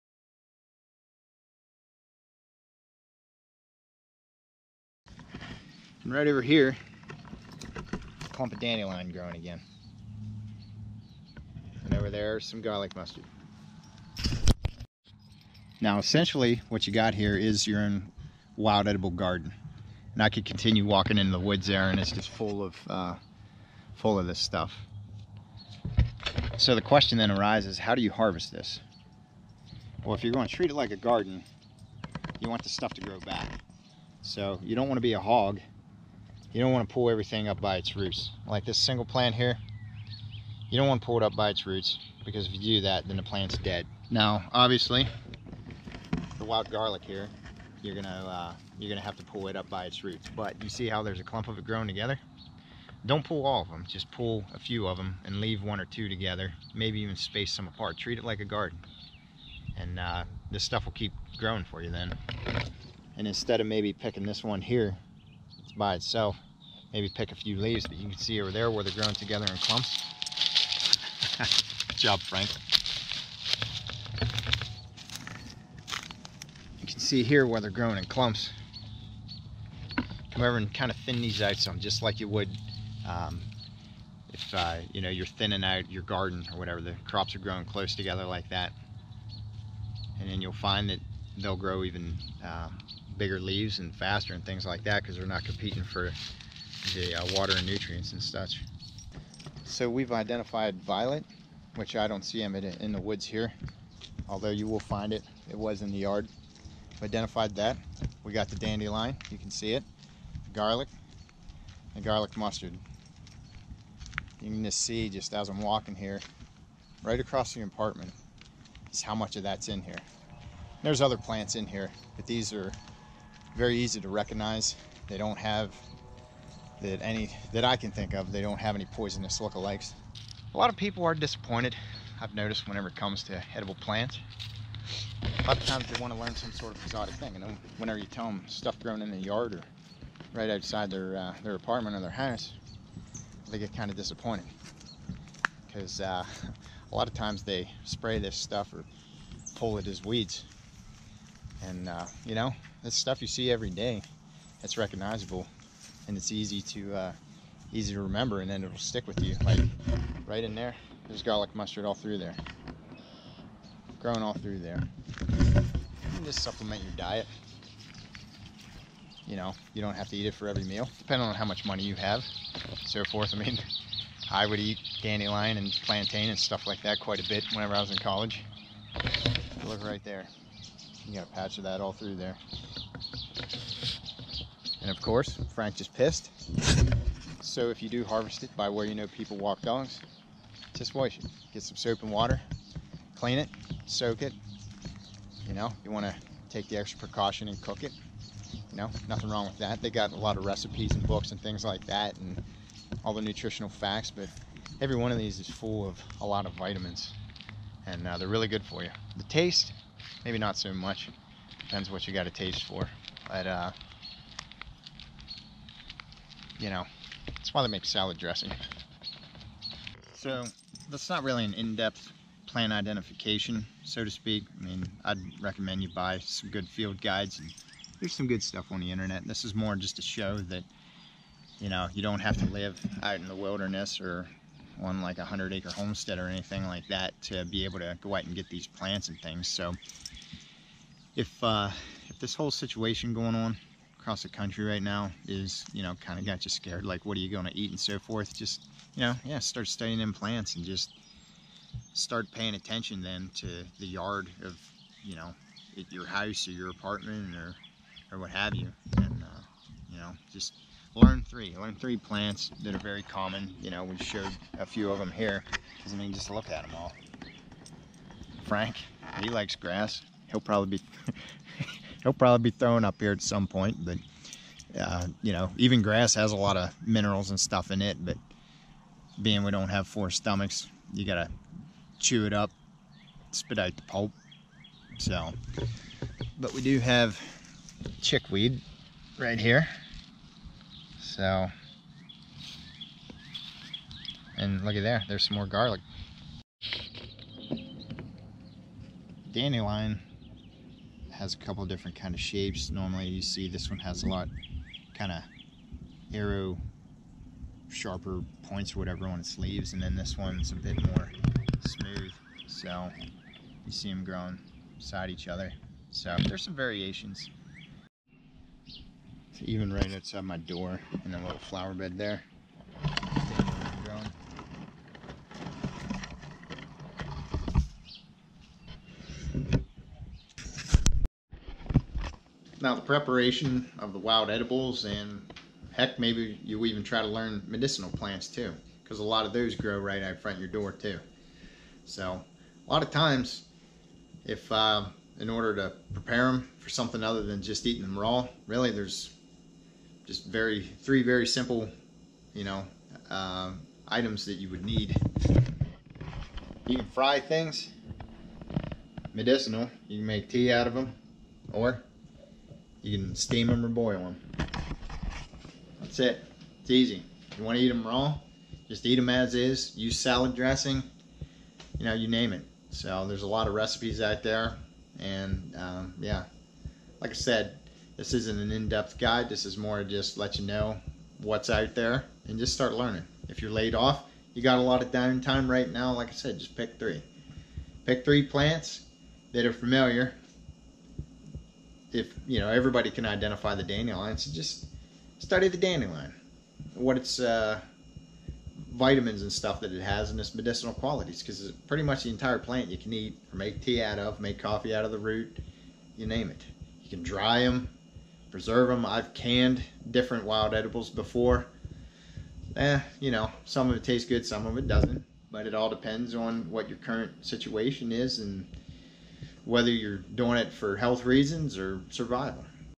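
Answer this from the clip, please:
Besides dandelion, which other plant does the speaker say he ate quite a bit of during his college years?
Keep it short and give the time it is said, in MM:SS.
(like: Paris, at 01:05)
plantain, at 02:55.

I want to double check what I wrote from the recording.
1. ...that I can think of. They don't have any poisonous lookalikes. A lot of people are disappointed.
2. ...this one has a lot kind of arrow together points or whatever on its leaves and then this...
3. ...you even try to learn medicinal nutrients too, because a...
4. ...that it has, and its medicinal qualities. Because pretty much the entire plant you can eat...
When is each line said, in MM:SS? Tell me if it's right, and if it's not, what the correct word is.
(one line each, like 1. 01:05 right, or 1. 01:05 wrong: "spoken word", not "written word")
1. 02:07 right
2. 05:03 wrong: "sharper", not "together"
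3. 05:36 wrong: "plants", not "nutrients"
4. 06:39 right.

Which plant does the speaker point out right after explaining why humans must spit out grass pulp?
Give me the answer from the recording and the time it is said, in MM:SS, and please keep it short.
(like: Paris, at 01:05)
chickweed, at 04:48.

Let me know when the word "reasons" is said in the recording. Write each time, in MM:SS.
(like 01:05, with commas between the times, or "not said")
07:01.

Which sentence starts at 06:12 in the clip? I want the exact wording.
So there's a lot of recipes out there, and um, yeah, like I said, this isn't an in depth guide.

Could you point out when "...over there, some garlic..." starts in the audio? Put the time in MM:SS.
00:11.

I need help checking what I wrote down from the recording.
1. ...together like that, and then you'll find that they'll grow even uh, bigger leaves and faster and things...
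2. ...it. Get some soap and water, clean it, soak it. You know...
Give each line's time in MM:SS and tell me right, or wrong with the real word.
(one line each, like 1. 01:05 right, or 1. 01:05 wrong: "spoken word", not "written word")
1. 01:27 right
2. 03:11 right.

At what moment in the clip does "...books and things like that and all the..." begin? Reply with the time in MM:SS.
03:21.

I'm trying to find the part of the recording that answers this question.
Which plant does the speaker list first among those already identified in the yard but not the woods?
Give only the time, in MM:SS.
01:40.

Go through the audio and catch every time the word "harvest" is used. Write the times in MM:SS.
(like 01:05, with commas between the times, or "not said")
00:28, 03:08.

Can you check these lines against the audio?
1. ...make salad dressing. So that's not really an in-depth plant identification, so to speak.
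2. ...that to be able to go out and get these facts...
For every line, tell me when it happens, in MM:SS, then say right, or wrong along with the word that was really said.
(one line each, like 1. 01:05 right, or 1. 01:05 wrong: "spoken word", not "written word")
1. 03:37 right
2. 03:56 wrong: "plants", not "facts".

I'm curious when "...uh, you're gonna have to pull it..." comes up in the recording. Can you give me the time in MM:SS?
00:48.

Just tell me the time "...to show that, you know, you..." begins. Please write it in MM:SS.
03:49.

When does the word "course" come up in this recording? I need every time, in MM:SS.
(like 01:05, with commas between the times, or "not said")
03:05.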